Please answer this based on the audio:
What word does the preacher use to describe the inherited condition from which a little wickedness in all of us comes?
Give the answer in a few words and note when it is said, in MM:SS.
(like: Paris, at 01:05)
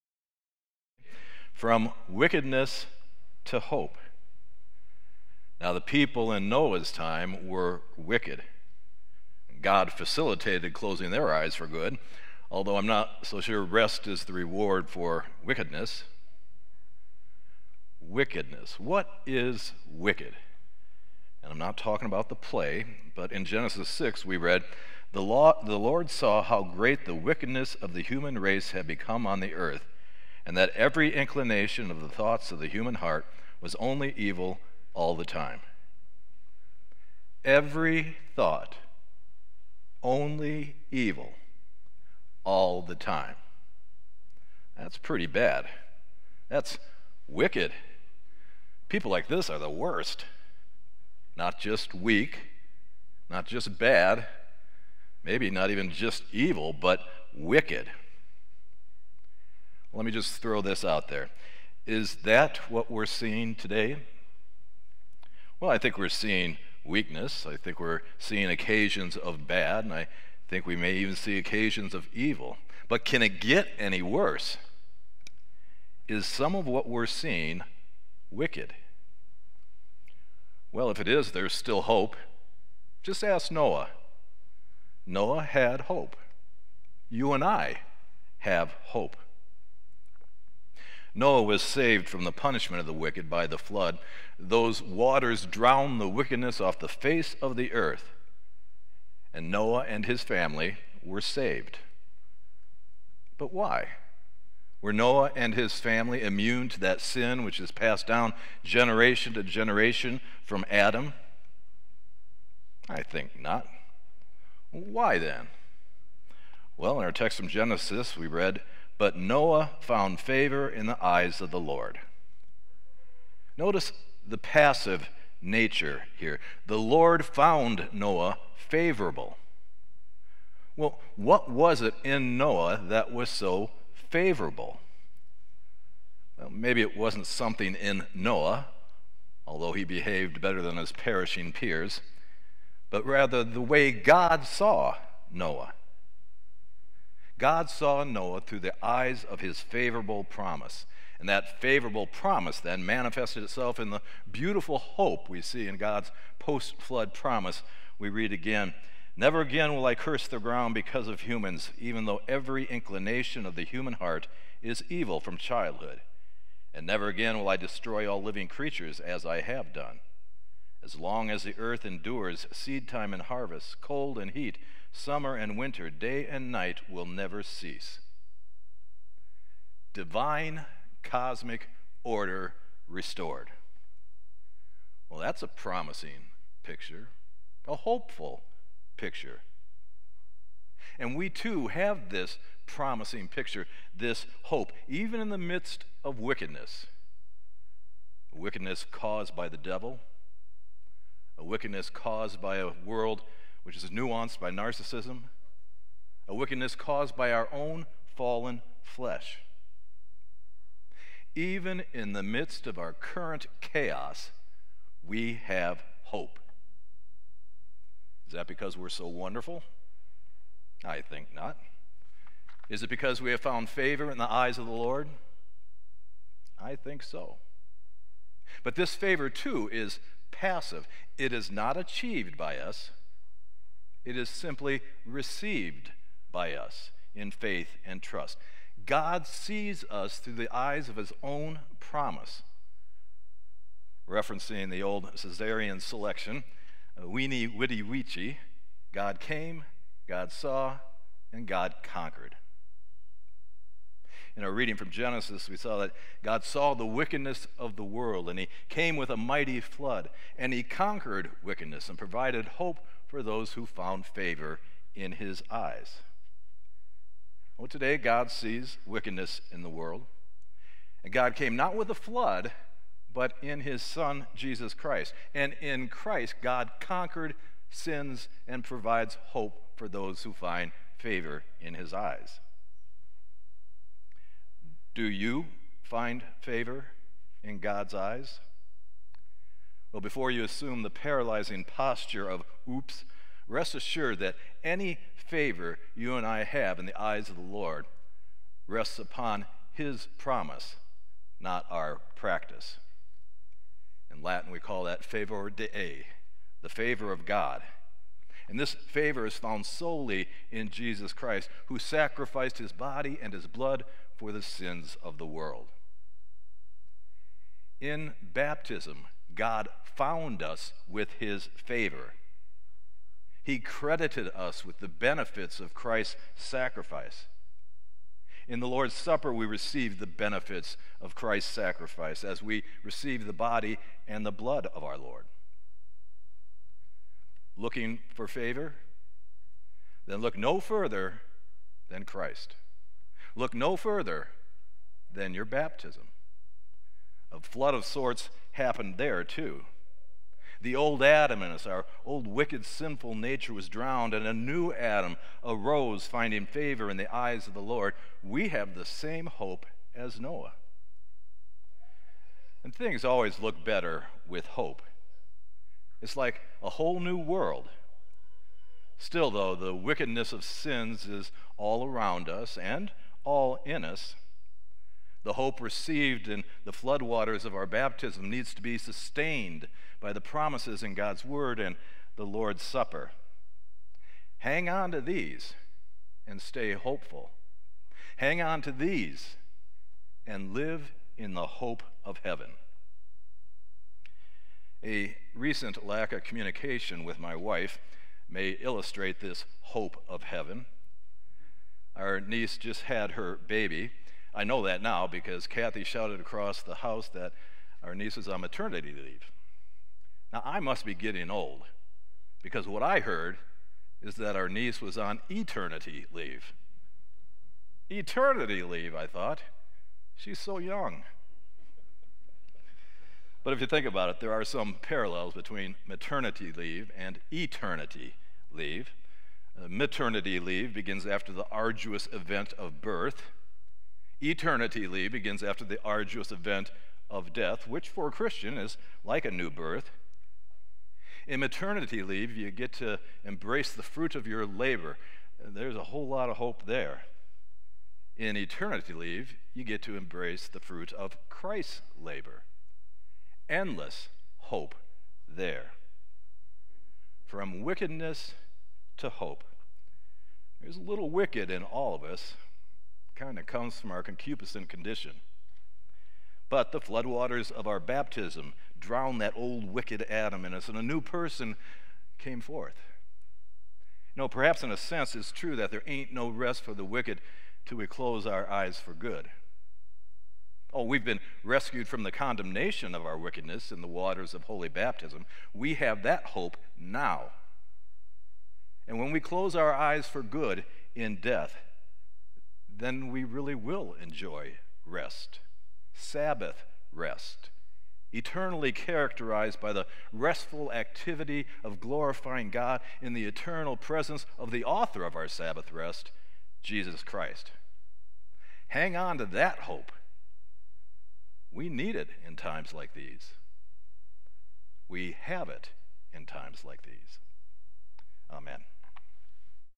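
concupiscent, at 07:44.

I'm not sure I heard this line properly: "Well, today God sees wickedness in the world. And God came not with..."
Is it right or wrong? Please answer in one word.
right.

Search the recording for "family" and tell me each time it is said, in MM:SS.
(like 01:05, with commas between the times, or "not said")
01:40, 01:45.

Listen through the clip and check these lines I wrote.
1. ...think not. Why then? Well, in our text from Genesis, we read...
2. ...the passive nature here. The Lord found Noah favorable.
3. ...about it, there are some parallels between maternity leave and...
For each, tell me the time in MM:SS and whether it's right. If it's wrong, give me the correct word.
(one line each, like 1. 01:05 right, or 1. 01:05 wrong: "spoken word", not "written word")
1. 01:53 right
2. 02:04 right
3. 07:03 right.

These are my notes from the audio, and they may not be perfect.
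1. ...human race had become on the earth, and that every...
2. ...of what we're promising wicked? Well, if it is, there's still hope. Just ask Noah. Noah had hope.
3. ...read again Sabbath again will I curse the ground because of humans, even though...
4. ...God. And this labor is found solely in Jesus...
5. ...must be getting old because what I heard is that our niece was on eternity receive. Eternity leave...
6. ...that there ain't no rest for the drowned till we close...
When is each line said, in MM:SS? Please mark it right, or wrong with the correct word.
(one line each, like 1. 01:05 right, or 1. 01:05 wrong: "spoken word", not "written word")
1. 00:28 right
2. 01:16 wrong: "seeing", not "promising"
3. 02:38 wrong: "Never", not "Sabbath"
4. 05:07 wrong: "favor", not "labor"
5. 06:50 wrong: "leave", not "receive"
6. 07:55 wrong: "wicked", not "drowned".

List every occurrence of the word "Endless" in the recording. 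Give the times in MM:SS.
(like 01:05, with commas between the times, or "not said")
07:33.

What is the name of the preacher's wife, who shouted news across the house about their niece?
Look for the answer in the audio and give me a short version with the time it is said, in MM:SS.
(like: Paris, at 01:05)
Kathy, at 06:45.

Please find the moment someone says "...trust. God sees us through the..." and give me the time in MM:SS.
03:58.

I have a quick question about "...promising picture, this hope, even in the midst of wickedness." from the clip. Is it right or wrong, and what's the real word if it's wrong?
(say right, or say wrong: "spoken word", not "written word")
right.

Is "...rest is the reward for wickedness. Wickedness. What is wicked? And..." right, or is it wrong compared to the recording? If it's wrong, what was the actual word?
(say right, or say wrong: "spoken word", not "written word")
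right.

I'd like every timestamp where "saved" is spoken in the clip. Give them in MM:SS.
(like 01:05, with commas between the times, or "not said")
01:31, 01:41.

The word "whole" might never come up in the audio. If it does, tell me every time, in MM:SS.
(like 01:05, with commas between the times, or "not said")
06:06, 07:25.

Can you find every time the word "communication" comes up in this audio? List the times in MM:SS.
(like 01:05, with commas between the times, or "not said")
06:36.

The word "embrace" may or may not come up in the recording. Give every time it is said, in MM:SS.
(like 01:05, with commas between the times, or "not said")
07:23, 07:29.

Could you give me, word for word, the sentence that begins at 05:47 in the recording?
A flood of sorts happened there, too.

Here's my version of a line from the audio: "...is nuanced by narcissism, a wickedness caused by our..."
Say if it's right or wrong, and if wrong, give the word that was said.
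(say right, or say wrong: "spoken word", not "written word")
right.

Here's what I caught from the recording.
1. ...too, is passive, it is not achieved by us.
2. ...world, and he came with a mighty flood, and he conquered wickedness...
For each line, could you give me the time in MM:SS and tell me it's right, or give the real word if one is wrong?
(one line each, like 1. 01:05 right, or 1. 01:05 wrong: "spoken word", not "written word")
1. 03:49 right
2. 04:17 right.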